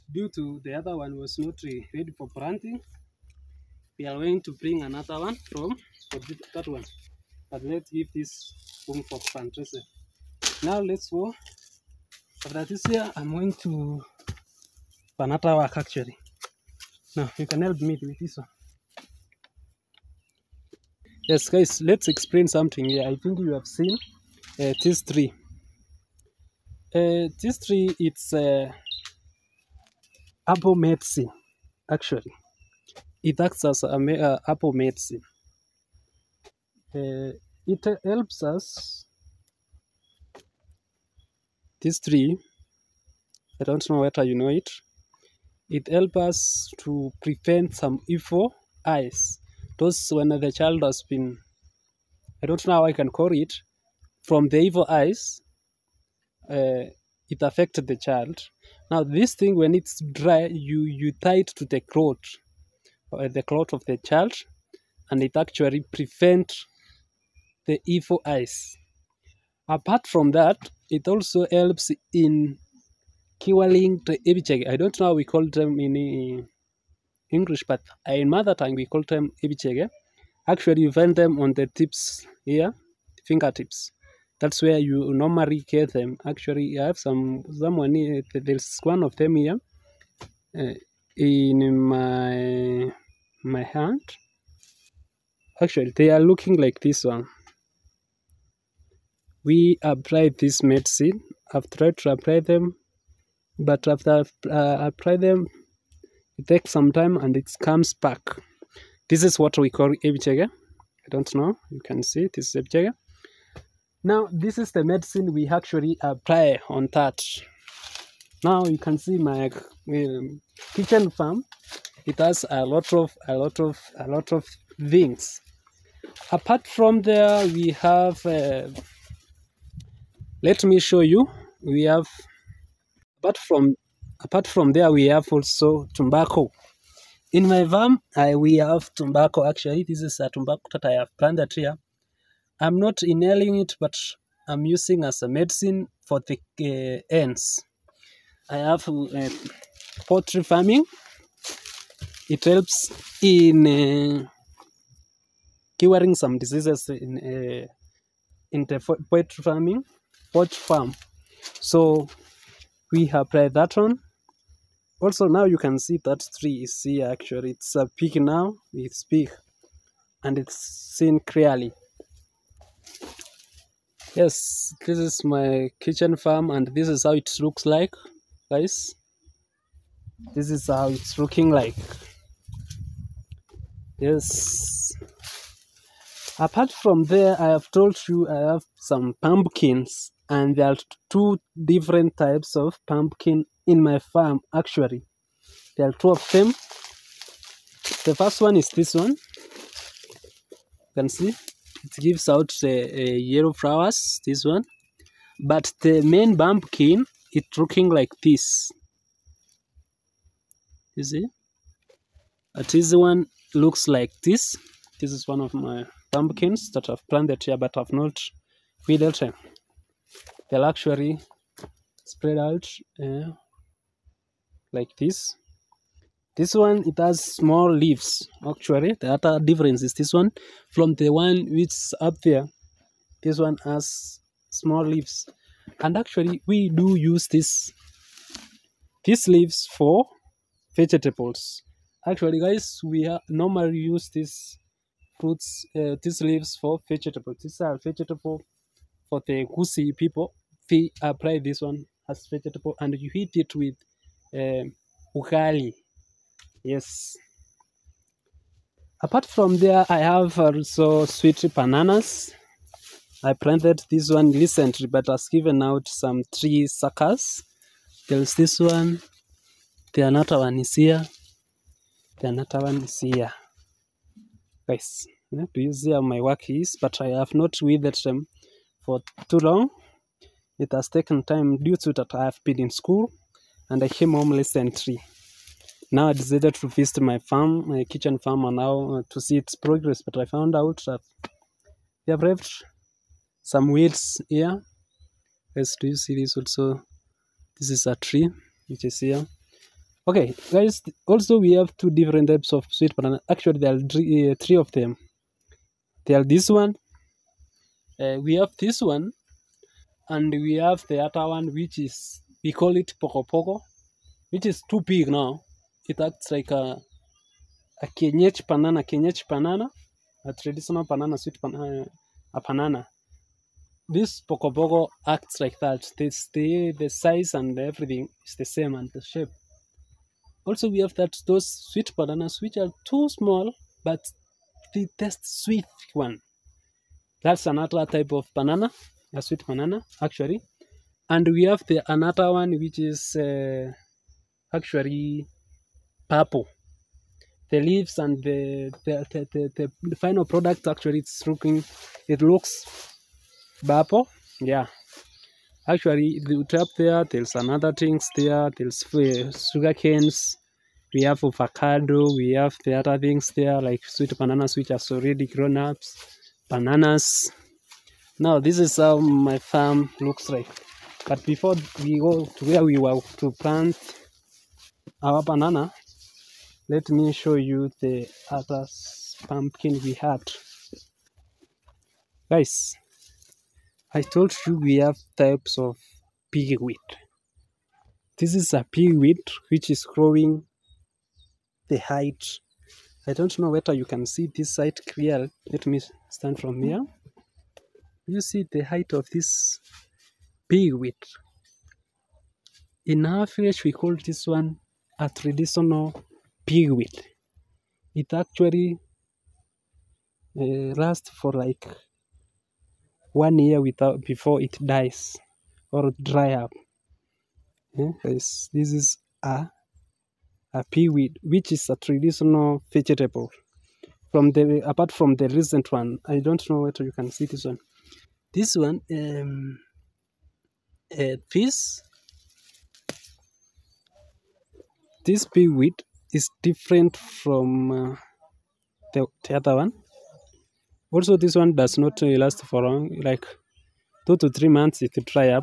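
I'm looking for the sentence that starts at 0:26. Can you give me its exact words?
Uh, this uh, it's uh, apple medicine actually it acts as a uh, apple medicine uh, it helps us This tree.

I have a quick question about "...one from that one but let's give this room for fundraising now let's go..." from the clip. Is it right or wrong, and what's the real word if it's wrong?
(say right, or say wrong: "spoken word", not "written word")
right.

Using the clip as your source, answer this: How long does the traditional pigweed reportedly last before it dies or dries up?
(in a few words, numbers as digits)
one year.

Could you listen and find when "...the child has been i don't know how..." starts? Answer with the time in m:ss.
0:50.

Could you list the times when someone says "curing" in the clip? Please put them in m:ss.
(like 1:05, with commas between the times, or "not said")
1:13, 2:35.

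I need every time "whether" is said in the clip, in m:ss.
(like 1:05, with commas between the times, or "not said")
0:44, 6:33, 7:06.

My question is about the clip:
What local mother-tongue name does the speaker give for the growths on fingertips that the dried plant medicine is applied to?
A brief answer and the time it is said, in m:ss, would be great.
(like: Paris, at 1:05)
ibichege, at 1:19.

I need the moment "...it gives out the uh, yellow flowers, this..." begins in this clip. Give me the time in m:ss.
3:21.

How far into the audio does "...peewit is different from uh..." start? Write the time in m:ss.
7:15.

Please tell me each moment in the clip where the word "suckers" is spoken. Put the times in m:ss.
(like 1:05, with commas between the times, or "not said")
4:26.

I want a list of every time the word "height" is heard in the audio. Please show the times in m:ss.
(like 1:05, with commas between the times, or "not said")
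6:31, 6:38.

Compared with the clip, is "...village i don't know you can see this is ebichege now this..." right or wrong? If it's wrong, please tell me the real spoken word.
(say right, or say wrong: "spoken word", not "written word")
wrong: "ebichege", not "village".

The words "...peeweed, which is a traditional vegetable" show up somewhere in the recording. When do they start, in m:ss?
7:00.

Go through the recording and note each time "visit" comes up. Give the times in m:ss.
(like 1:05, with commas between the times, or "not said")
4:46.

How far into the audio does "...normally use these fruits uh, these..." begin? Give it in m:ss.
4:03.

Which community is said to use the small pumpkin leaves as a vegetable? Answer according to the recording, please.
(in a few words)
Gusii.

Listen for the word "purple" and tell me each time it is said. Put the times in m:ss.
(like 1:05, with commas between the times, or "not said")
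5:46, 5:53.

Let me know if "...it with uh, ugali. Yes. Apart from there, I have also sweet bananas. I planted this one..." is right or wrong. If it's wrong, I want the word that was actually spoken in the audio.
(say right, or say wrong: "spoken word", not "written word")
right.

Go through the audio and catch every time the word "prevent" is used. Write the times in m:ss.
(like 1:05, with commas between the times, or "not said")
0:47, 1:05.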